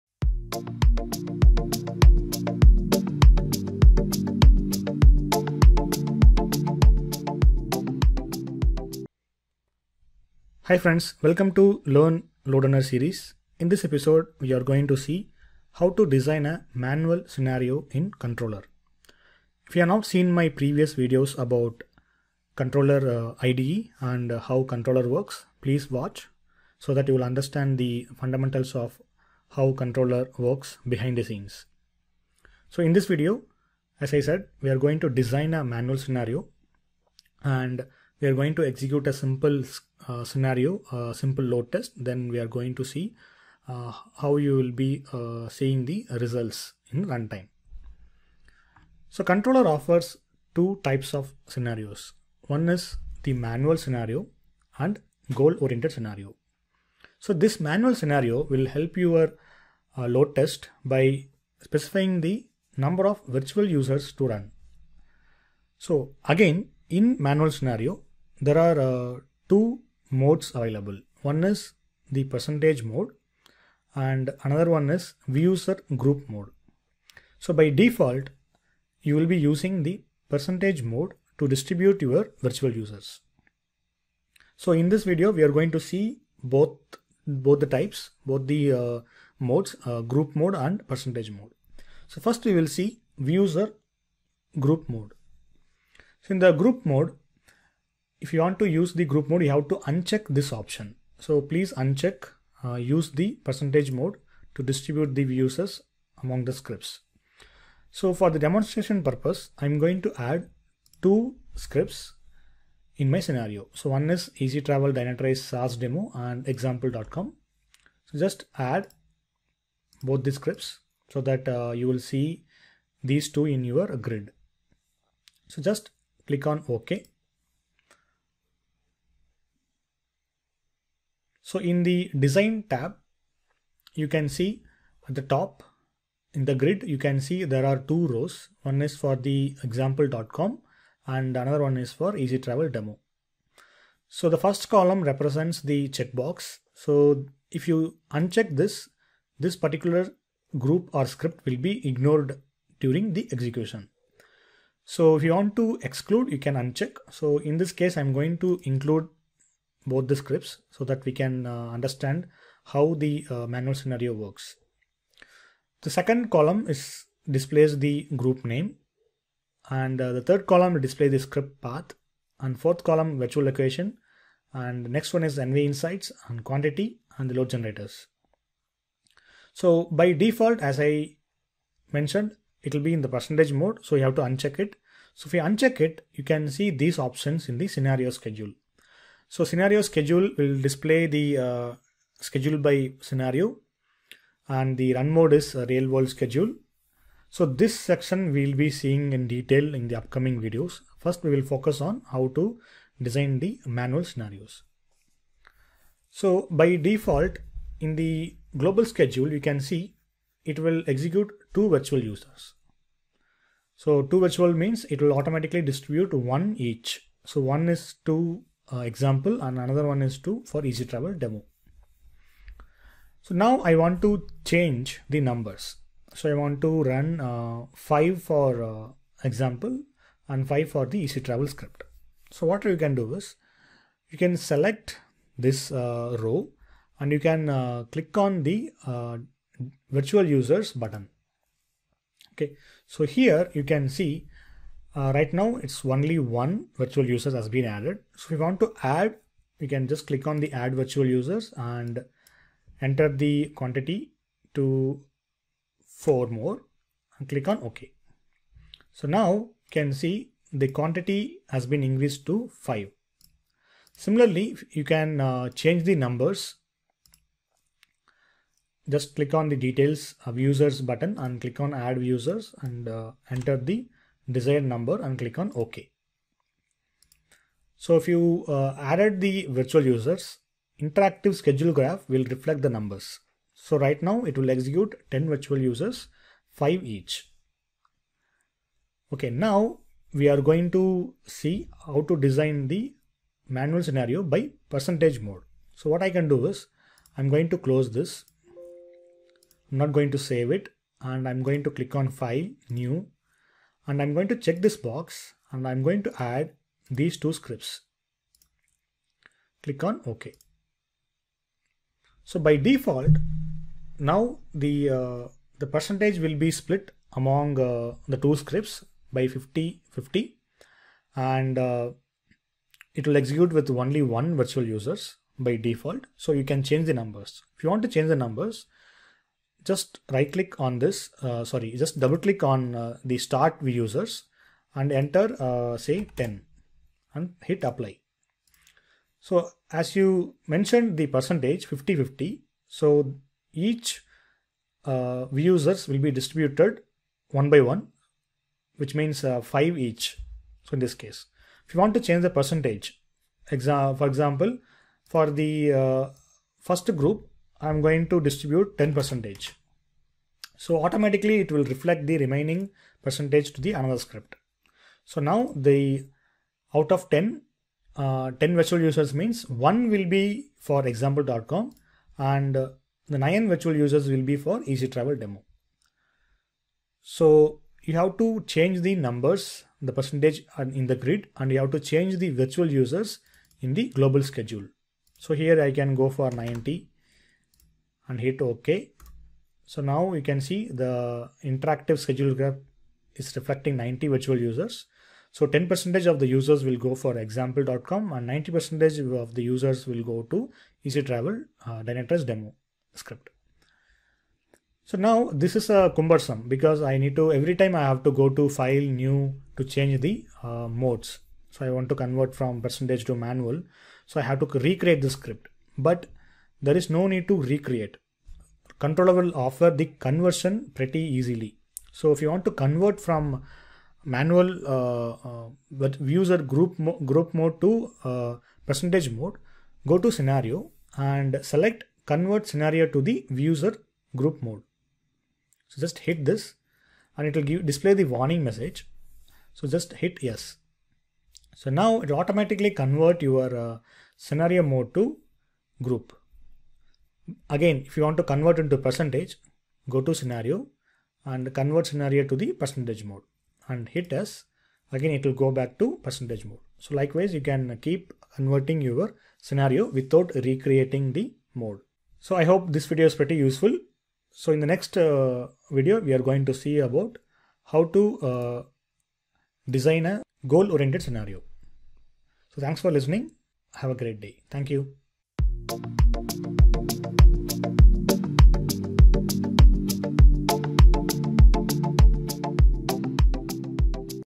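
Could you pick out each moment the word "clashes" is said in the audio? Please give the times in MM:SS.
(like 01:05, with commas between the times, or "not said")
not said.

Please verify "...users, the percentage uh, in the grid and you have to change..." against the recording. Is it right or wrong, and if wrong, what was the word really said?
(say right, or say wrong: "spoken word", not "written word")
wrong: "numbers", not "users".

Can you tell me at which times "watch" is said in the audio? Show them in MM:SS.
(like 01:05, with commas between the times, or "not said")
00:25.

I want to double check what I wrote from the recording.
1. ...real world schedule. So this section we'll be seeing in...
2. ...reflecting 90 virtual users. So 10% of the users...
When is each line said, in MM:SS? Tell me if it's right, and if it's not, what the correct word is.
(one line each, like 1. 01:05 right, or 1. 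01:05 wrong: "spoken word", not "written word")
1. 03:15 right
2. 06:33 right.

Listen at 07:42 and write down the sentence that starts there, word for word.
So I hope this video is pretty useful.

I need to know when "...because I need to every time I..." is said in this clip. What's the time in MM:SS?
06:46.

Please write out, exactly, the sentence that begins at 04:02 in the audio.
Okay, so here you can see uh, right now, it's only one virtual users has been added.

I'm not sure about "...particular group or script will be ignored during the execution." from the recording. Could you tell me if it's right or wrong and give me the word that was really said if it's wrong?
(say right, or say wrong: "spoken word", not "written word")
right.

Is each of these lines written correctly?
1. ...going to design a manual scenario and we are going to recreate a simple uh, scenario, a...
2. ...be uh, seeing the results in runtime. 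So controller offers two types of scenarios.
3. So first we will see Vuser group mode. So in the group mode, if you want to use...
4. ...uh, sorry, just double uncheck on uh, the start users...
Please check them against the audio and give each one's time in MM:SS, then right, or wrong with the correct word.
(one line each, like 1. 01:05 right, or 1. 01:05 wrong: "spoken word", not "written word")
1. 00:34 wrong: "execute", not "recreate"
2. 00:44 right
3. 01:32 right
4. 05:31 wrong: "click", not "uncheck".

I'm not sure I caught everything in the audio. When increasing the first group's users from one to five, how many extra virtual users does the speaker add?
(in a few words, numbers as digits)
4.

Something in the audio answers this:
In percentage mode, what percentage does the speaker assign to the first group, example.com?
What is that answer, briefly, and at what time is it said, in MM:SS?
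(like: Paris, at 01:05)
10%, at 05:58.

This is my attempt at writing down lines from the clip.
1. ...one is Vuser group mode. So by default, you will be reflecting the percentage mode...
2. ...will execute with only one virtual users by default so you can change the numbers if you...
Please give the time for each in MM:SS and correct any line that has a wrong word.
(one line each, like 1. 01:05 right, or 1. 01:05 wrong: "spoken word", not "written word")
1. 01:14 wrong: "using", not "reflecting"
2. 05:23 right.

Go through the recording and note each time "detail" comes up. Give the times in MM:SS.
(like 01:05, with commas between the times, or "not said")
03:19, 04:29.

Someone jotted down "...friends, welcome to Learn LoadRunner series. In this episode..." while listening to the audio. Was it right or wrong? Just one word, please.
right.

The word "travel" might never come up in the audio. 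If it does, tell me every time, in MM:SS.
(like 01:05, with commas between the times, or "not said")
01:54, 02:22, 03:40, 03:51, 06:14, 06:41.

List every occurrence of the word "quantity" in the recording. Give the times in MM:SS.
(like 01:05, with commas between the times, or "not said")
02:56, 04:13, 04:20.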